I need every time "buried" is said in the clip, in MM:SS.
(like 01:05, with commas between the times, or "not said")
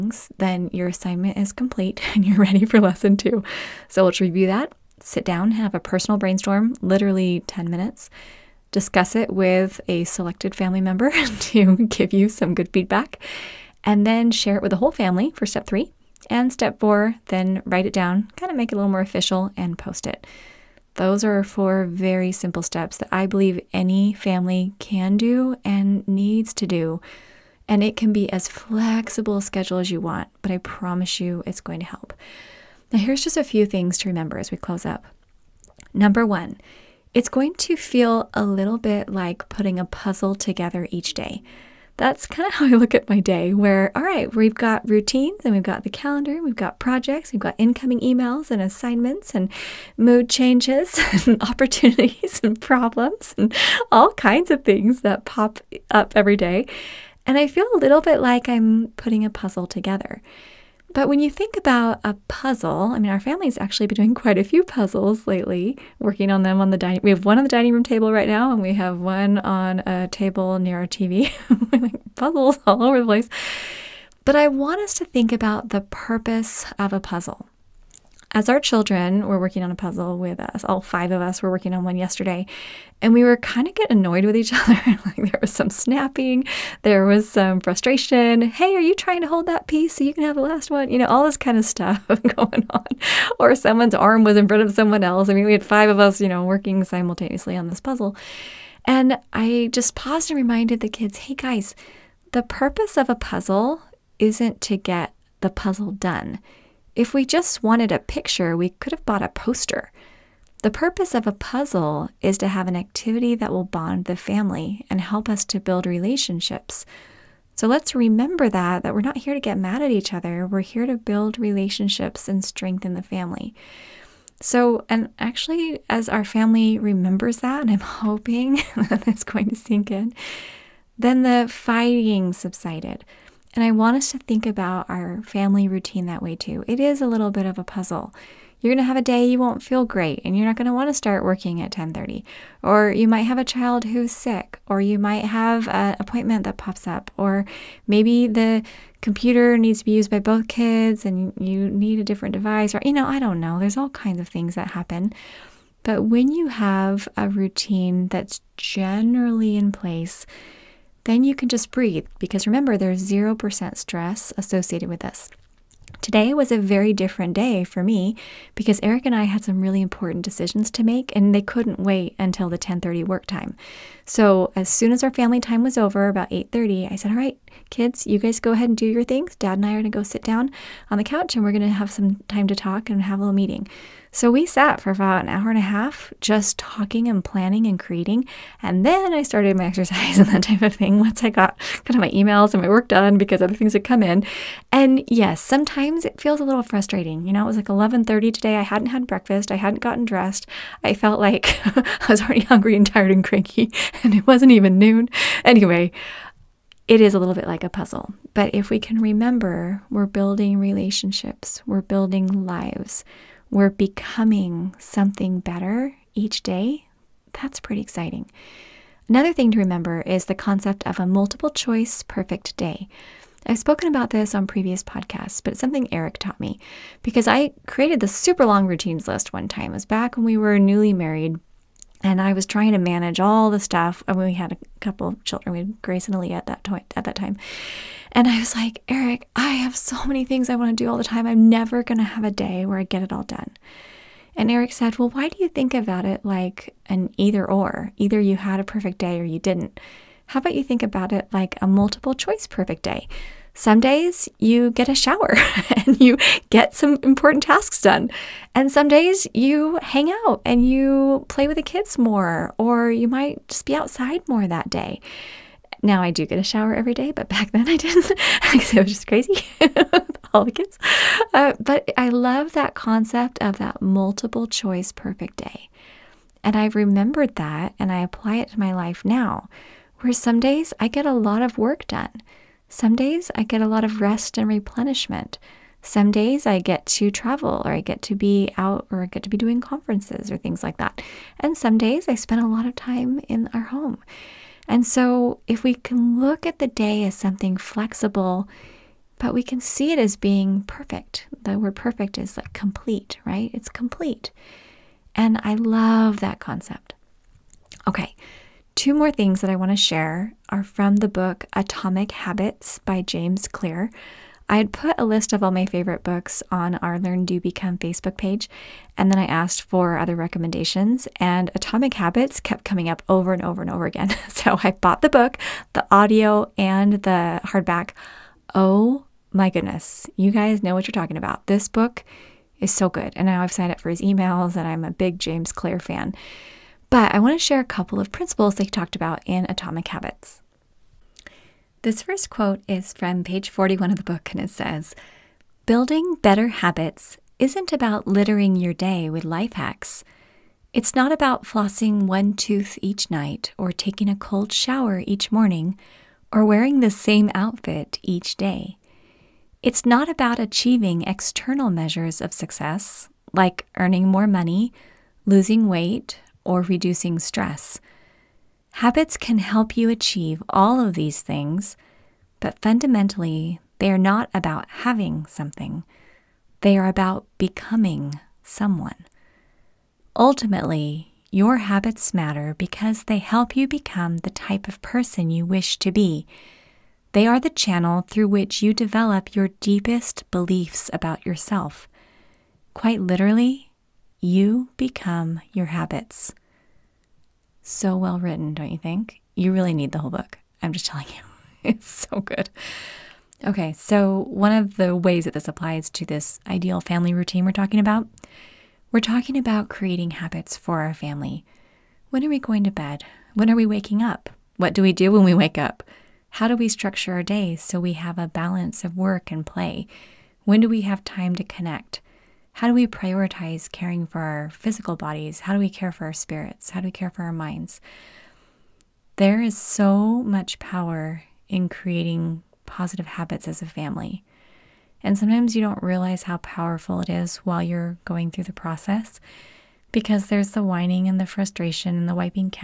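not said.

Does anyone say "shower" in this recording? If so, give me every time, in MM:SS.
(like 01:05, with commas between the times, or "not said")
04:14, 04:26, 05:54.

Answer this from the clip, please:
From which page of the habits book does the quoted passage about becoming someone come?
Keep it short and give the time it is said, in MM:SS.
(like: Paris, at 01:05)
41, at 05:43.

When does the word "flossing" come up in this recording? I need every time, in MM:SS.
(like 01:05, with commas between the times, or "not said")
05:51.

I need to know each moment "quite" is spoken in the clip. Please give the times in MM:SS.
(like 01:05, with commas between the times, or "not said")
01:04, 06:32.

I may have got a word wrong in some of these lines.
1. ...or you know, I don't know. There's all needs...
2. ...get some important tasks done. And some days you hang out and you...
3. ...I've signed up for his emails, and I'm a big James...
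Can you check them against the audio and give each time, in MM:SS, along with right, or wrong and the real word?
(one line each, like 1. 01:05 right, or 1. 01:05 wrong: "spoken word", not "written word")
1. 02:32 wrong: "kinds", not "needs"
2. 04:16 right
3. 05:33 right.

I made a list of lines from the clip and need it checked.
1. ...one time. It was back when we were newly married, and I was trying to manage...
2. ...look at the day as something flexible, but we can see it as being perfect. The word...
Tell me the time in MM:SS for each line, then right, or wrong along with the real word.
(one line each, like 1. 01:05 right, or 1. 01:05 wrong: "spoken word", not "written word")
1. 03:49 right
2. 04:56 right.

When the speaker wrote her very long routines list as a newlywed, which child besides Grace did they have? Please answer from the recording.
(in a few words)
Aaliyah.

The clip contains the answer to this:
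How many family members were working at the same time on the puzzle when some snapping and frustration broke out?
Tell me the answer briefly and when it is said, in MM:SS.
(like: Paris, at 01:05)
5, at 01:20.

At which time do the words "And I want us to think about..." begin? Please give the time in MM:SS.
02:13.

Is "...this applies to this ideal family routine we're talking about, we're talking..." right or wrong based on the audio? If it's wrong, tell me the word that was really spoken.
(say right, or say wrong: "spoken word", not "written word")
right.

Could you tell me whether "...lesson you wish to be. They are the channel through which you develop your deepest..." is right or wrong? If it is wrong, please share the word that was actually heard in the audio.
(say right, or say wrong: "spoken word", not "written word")
wrong: "person", not "lesson".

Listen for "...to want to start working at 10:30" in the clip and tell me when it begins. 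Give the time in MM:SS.
02:20.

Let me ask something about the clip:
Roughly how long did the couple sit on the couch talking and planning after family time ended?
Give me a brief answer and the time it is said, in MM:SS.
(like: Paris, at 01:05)
an hour and a half, at 03:04.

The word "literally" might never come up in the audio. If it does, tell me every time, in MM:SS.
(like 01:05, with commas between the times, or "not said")
00:06, 06:33.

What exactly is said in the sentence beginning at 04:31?
Uh, but I love that concept of that multiple choice perfect day.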